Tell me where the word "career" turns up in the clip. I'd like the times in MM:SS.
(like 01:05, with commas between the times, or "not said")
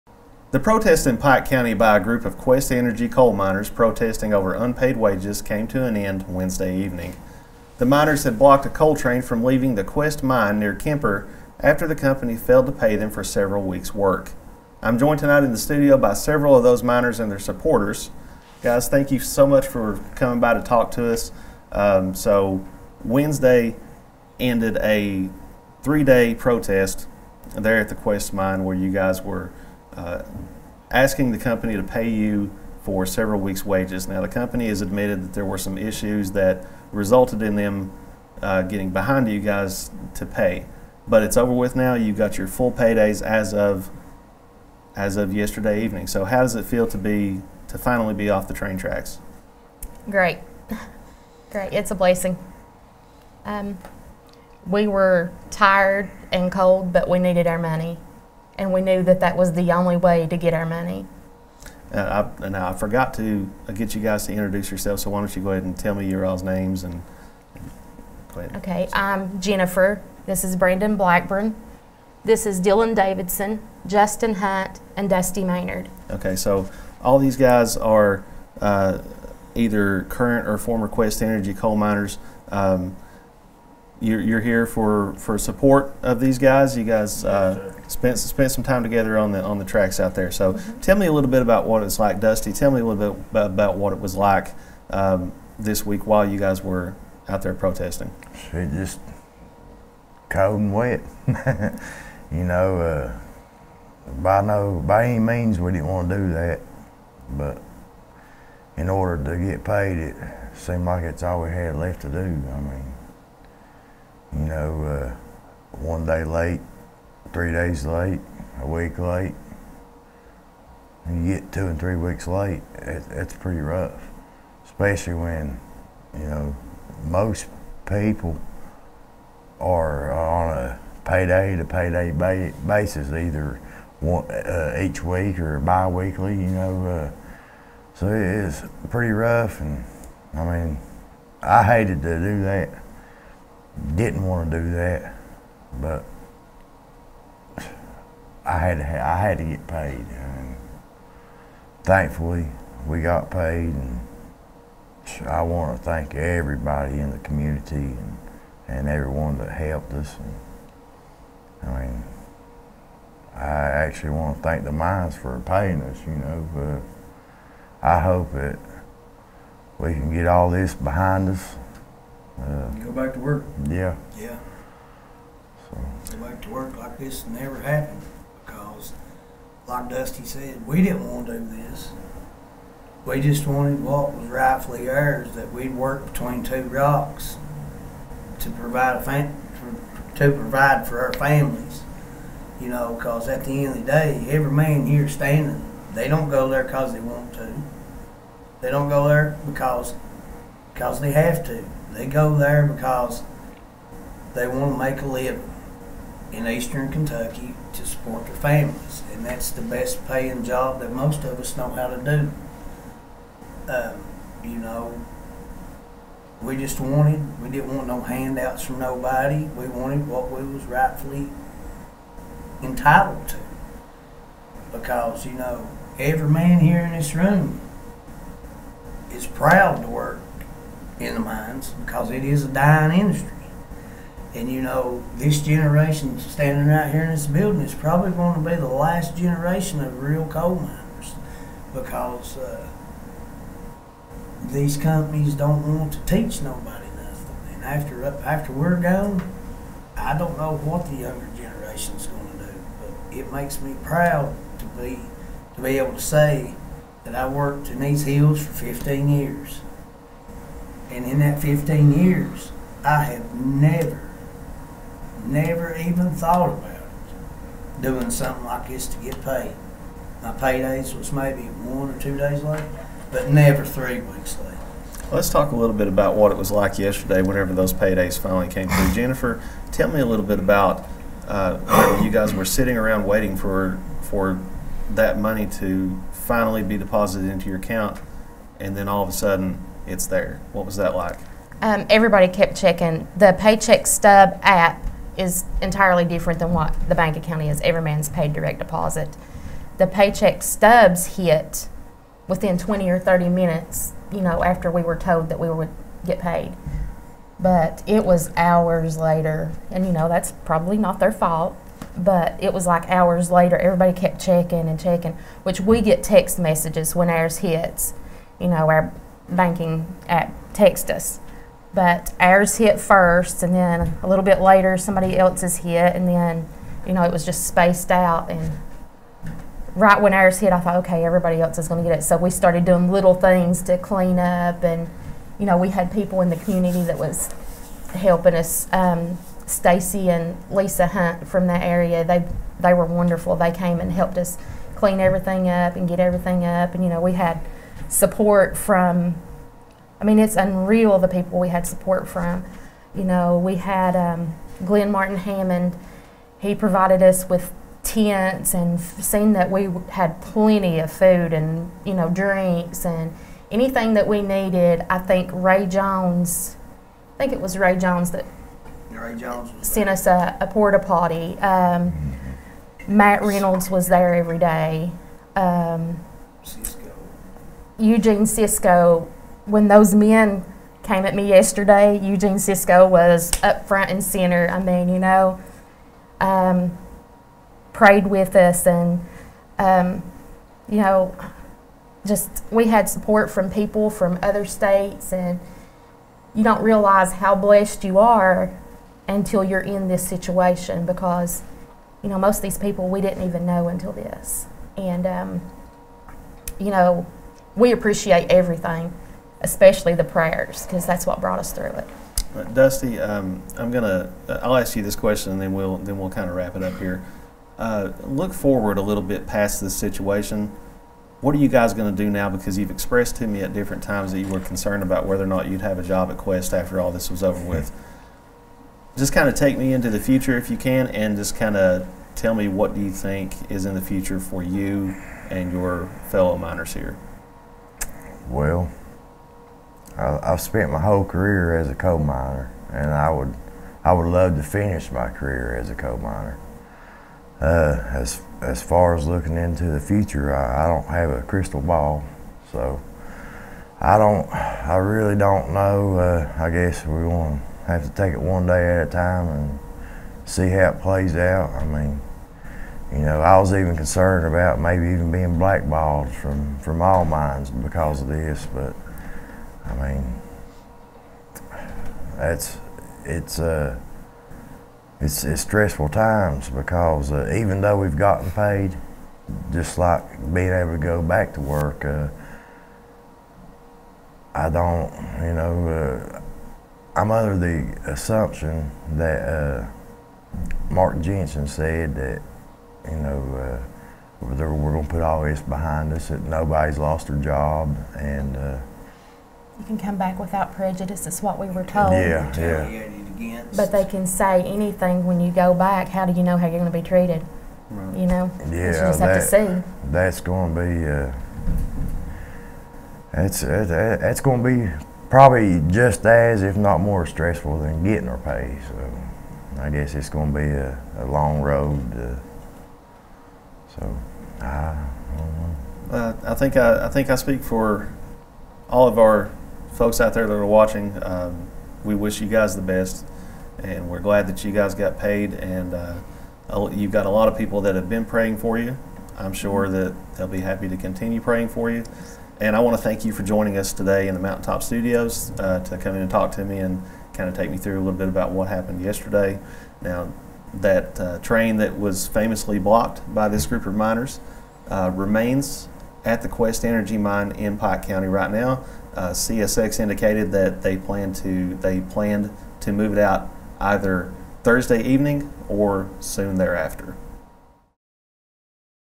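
07:21, 07:25.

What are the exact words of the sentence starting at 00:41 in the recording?
You got your full paydays as of as of yesterday evening.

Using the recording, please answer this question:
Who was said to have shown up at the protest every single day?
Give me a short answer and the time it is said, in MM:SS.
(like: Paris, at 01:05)
Matt Reynolds, at 06:12.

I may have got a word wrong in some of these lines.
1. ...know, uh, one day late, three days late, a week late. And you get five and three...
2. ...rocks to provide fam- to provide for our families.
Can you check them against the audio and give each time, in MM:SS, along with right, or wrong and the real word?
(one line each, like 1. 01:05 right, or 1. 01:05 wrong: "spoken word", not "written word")
1. 01:54 wrong: "two", not "five"
2. 03:06 right.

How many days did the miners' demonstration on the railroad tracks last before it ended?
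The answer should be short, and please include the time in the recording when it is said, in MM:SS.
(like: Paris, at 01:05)
3, at 00:25.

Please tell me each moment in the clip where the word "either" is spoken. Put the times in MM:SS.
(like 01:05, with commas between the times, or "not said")
01:19, 02:13, 09:23.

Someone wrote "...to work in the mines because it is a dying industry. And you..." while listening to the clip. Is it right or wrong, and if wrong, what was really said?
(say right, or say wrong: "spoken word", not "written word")
right.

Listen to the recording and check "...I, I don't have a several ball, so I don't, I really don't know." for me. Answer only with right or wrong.
wrong.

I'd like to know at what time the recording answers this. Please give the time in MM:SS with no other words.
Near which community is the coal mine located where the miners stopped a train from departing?
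00:10.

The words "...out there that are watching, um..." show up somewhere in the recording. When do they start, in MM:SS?
08:50.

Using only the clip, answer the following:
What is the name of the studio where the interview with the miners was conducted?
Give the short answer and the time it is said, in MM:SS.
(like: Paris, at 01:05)
Mountaintop Studios, at 09:04.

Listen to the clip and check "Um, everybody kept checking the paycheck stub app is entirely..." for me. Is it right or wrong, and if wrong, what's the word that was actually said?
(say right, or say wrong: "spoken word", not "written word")
right.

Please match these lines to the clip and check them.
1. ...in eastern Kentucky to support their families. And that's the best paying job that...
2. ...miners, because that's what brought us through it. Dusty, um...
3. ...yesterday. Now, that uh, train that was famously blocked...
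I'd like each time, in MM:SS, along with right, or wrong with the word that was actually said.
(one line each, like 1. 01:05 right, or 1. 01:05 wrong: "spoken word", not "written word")
1. 03:26 right
2. 06:50 wrong: "prayers", not "miners"
3. 09:08 right.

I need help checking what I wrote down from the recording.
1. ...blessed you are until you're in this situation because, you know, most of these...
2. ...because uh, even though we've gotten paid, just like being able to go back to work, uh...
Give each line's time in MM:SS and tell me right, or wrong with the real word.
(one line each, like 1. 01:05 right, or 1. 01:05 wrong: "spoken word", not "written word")
1. 06:37 right
2. 07:56 right.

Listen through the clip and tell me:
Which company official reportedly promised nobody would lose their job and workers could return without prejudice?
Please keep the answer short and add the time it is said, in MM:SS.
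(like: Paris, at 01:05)
Mark Jensen, at 08:10.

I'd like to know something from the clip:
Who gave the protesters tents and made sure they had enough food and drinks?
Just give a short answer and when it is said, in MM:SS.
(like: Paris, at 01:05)
Glenn Martin Hammond, at 05:54.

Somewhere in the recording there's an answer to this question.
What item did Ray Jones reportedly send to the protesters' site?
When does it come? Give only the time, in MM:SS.
06:10.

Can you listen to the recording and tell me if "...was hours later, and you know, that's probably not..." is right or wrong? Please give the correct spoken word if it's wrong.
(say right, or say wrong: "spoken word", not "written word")
right.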